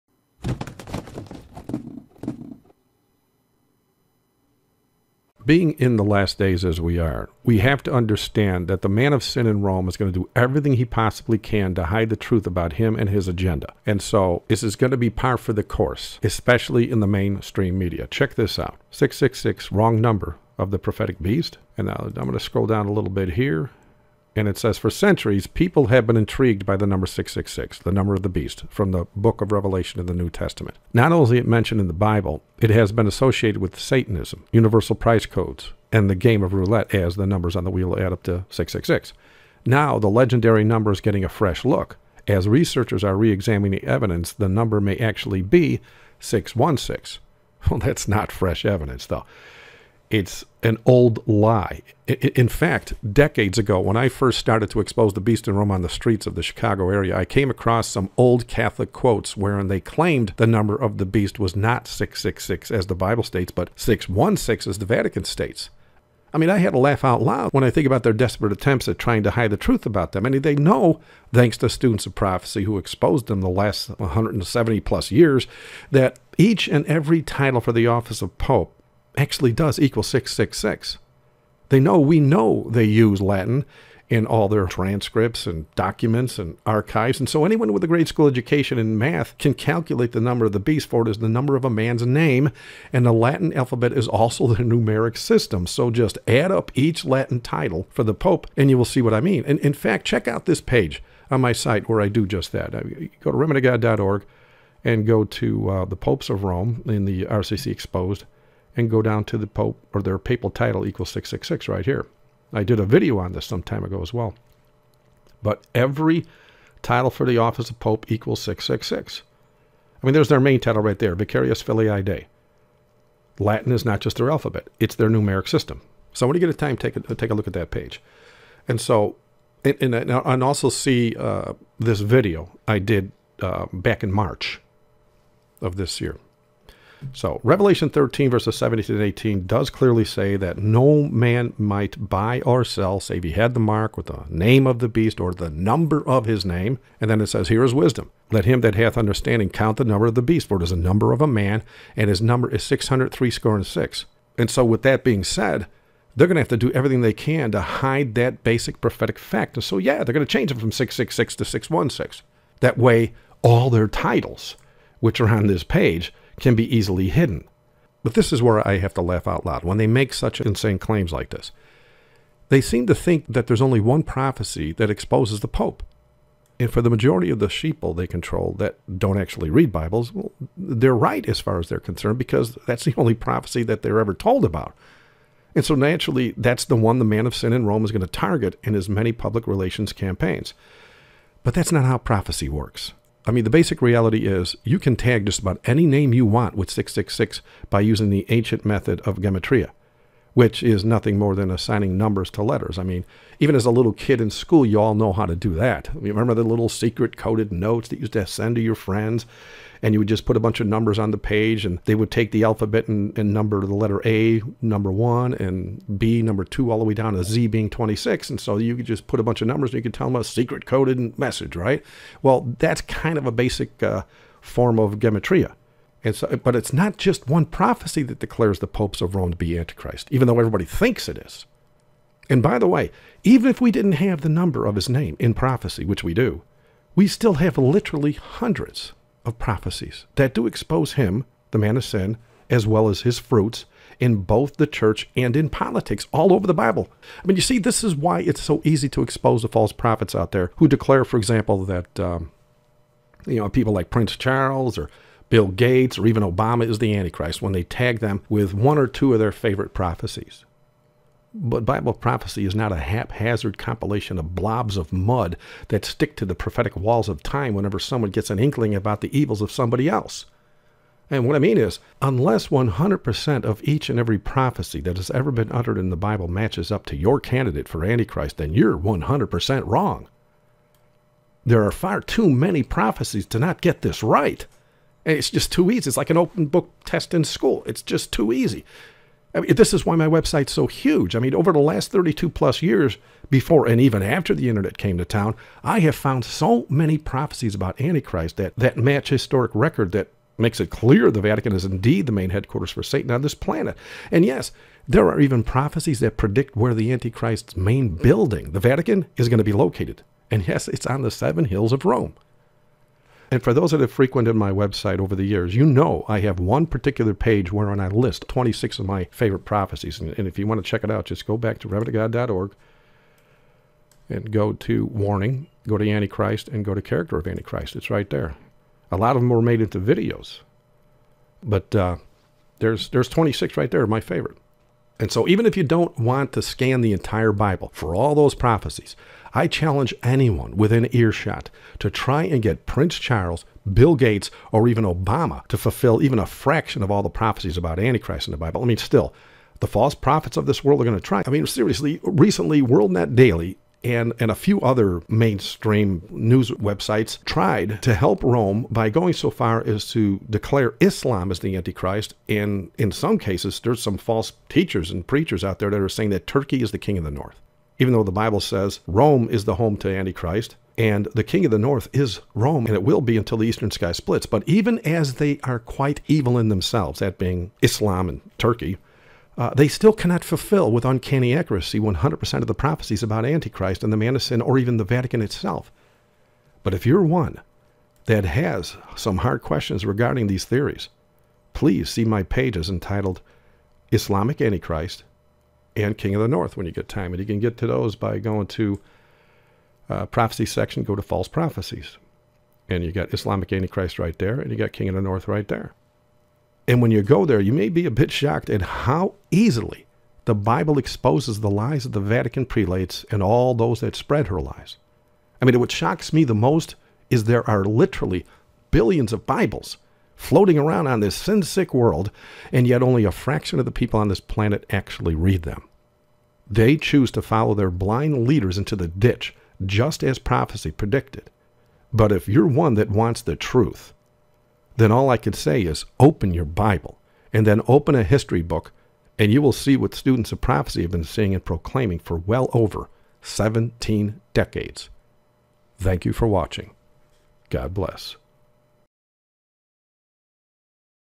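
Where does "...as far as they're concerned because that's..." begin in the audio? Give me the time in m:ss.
3:01.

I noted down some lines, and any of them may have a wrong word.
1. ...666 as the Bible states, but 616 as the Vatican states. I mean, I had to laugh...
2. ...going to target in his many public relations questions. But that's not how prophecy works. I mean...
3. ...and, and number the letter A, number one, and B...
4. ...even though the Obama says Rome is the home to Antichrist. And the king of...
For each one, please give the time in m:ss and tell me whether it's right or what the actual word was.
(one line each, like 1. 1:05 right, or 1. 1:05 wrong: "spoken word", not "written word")
1. 1:01 right
2. 3:07 wrong: "campaigns", not "questions"
3. 3:32 right
4. 6:07 wrong: "Bible", not "Obama".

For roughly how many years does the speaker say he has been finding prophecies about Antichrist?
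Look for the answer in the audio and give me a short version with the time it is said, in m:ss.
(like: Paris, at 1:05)
32, at 4:51.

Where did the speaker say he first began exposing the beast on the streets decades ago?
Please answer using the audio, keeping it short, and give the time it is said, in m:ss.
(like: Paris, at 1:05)
Chicago area, at 0:56.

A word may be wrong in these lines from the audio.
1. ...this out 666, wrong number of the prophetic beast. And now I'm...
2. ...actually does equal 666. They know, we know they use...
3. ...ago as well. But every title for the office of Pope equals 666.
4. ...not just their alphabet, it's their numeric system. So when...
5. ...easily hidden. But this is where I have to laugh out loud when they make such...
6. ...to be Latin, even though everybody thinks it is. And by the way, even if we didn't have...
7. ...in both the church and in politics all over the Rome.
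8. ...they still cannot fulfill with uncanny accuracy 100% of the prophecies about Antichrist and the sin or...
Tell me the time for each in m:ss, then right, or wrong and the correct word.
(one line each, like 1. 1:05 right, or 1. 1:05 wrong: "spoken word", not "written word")
1. 0:18 right
2. 1:19 right
3. 1:53 right
4. 2:03 right
5. 2:46 right
6. 3:49 wrong: "Antichrist", not "Latin"
7. 4:03 wrong: "Bible", not "Rome"
8. 6:19 right.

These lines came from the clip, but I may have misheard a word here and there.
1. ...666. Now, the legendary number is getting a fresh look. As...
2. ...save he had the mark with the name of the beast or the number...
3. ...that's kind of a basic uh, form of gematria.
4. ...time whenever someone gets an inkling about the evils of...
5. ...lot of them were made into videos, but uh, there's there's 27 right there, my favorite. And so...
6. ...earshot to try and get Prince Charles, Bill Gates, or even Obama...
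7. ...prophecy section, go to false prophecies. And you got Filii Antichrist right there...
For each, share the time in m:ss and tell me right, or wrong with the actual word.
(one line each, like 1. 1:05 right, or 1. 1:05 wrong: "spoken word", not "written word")
1. 0:38 right
2. 2:22 right
3. 3:42 right
4. 4:27 right
5. 5:28 wrong: "26", not "27"
6. 5:40 right
7. 6:40 wrong: "Islamic", not "Filii".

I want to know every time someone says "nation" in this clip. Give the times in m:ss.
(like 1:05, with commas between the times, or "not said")
not said.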